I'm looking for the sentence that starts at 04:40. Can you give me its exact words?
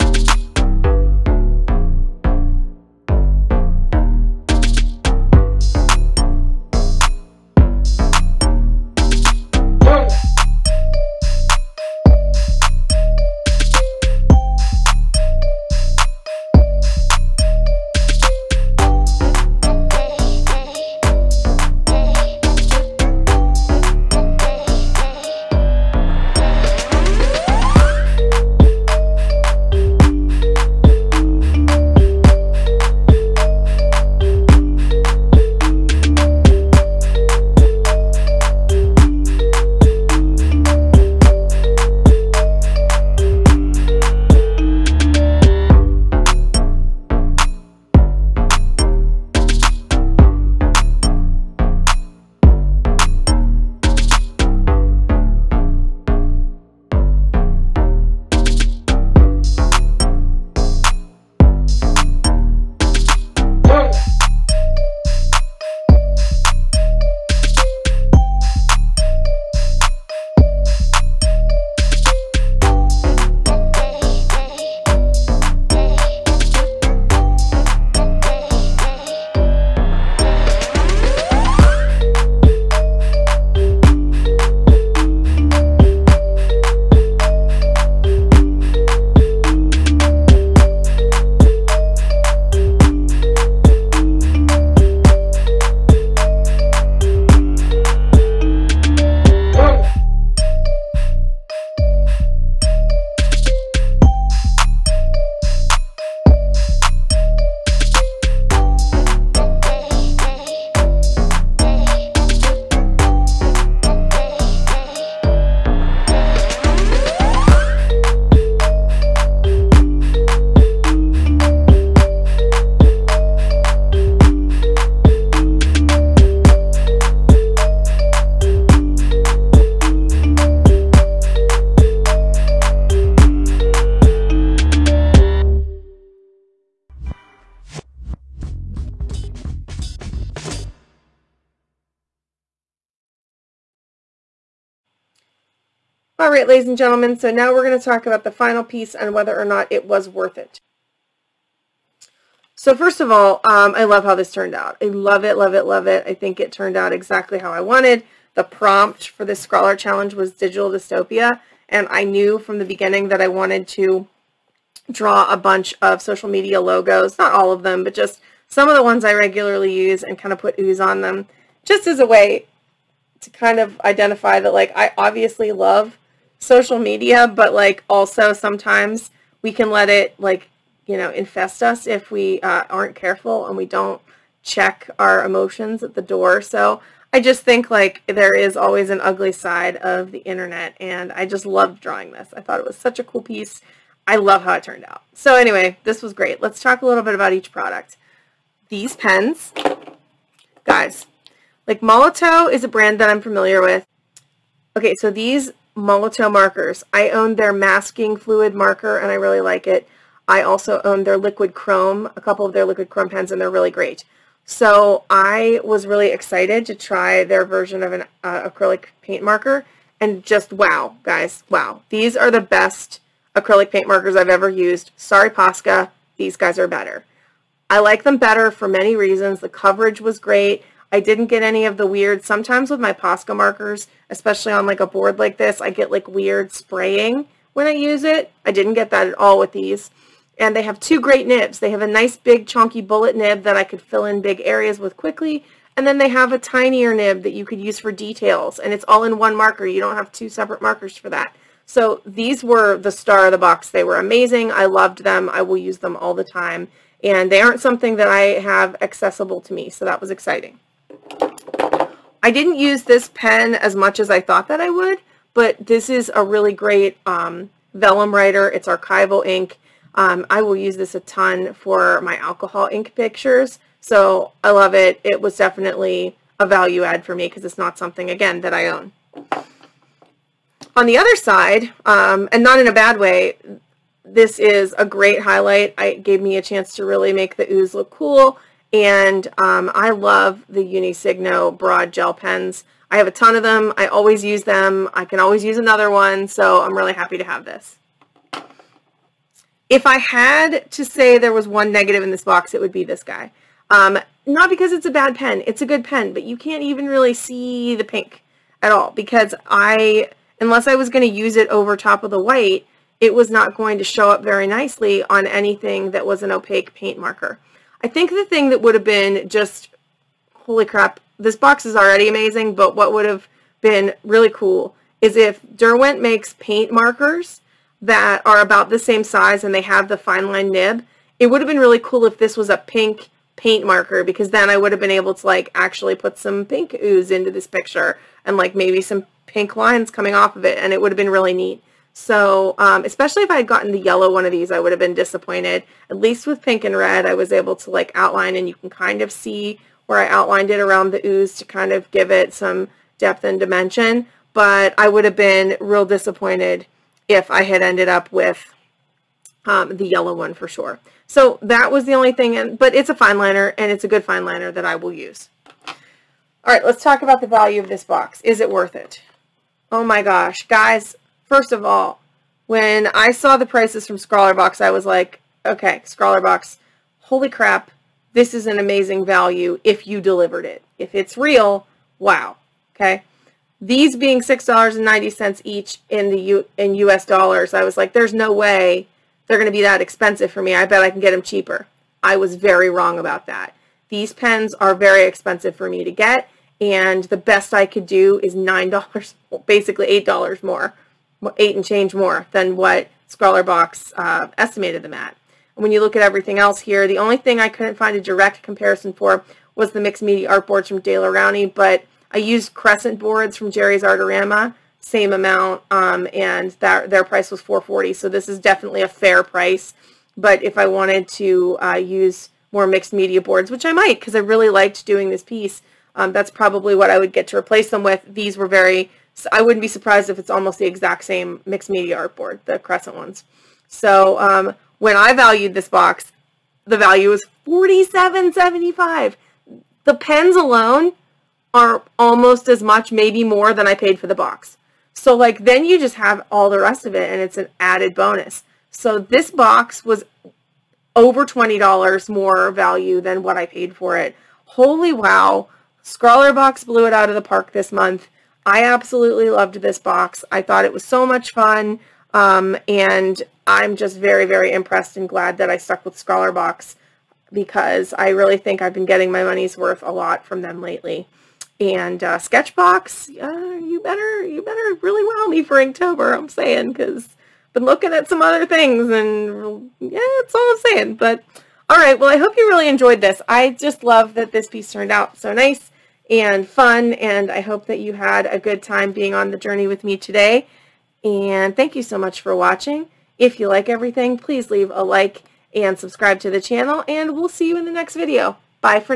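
On the other side, um, and not in a bad way, this is a great highlight.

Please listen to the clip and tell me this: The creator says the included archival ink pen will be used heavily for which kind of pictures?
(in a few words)
alcohol ink pictures.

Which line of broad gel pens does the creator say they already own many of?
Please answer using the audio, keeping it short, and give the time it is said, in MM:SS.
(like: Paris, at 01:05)
Uni Signo, at 04:50.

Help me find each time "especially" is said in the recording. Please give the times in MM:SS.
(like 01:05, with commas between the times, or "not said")
03:54, 05:42.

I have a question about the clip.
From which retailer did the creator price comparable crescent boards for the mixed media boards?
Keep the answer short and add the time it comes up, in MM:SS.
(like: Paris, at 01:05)
Jerry's Artorama, at 06:53.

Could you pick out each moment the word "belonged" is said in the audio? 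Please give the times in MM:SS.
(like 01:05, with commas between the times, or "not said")
not said.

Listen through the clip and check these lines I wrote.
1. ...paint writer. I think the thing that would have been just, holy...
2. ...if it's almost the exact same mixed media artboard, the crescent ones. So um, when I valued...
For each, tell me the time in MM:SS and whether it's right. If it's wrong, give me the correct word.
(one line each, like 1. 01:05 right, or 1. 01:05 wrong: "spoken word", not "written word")
1. 05:16 wrong: "marker", not "writer"
2. 07:10 right.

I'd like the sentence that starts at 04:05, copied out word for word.
And then they have a tinier nib that you could use for details.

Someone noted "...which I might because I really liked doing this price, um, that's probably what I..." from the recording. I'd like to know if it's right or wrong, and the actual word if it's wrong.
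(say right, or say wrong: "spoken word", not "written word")
wrong: "piece", not "price".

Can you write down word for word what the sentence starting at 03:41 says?
These are the best acrylic paint markers I've ever used.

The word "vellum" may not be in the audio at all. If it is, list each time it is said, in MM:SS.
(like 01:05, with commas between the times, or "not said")
04:27.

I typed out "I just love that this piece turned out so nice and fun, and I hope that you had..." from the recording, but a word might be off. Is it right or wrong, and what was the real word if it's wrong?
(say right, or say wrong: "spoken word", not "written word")
right.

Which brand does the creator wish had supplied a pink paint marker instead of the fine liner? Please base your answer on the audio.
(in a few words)
Derwent.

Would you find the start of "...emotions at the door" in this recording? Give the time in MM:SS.
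03:05.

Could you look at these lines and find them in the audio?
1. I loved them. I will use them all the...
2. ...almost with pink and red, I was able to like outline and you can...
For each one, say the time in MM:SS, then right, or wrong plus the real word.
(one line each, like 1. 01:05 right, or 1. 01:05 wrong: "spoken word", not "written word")
1. 04:14 right
2. 05:45 wrong: "least", not "almost".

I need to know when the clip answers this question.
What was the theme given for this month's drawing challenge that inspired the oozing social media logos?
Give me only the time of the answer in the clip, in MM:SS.
02:40.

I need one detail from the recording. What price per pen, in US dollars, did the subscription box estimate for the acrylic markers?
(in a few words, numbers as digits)
$6.90.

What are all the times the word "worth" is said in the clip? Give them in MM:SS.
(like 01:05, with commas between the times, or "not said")
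02:30, 06:08, 07:49.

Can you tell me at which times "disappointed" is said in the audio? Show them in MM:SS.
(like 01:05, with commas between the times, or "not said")
05:44, 05:55.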